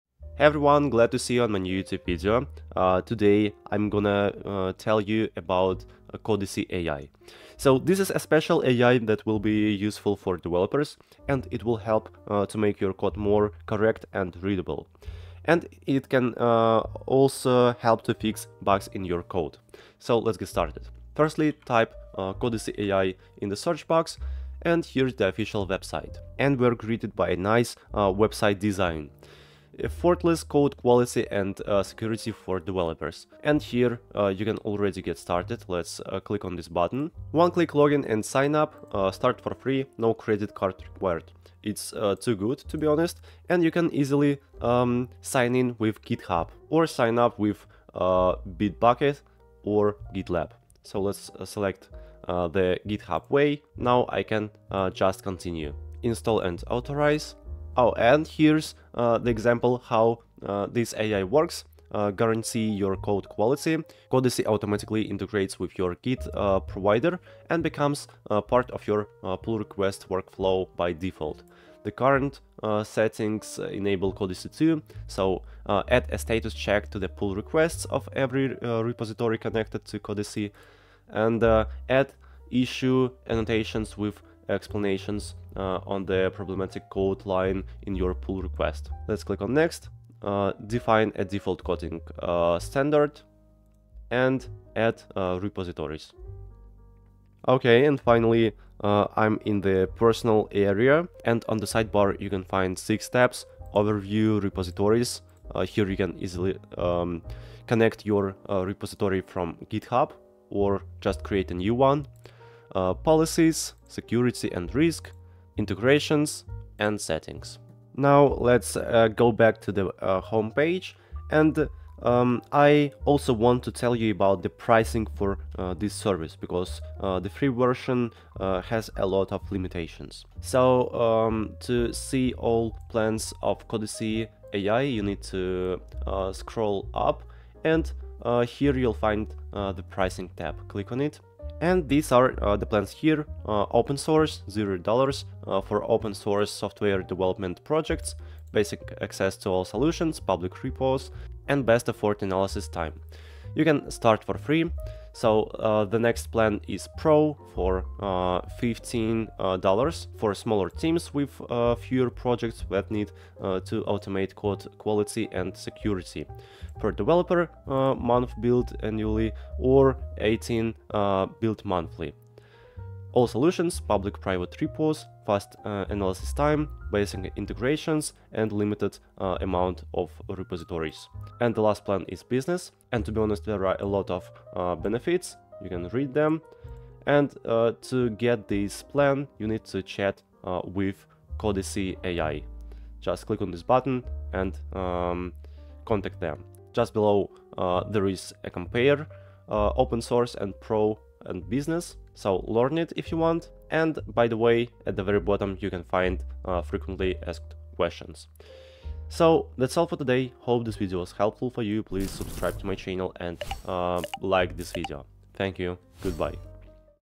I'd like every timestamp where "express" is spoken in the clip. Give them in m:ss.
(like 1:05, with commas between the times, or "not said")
not said.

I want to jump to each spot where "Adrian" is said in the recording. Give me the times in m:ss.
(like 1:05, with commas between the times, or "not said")
not said.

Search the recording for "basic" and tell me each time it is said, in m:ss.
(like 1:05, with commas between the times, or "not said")
2:28, 2:56.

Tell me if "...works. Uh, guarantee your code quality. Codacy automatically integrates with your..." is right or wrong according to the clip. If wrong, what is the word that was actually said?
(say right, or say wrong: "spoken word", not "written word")
right.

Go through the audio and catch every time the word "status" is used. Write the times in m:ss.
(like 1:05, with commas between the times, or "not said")
1:16.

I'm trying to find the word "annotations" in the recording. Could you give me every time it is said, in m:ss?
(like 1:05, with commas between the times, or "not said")
1:23.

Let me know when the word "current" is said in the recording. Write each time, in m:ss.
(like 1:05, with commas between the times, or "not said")
1:11.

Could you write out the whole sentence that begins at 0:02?
Uh, today I'm gonna uh, tell you about uh, Codacy AI.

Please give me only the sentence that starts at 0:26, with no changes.
And we're greeted by a nice website design effortless code quality and uh, security for developers.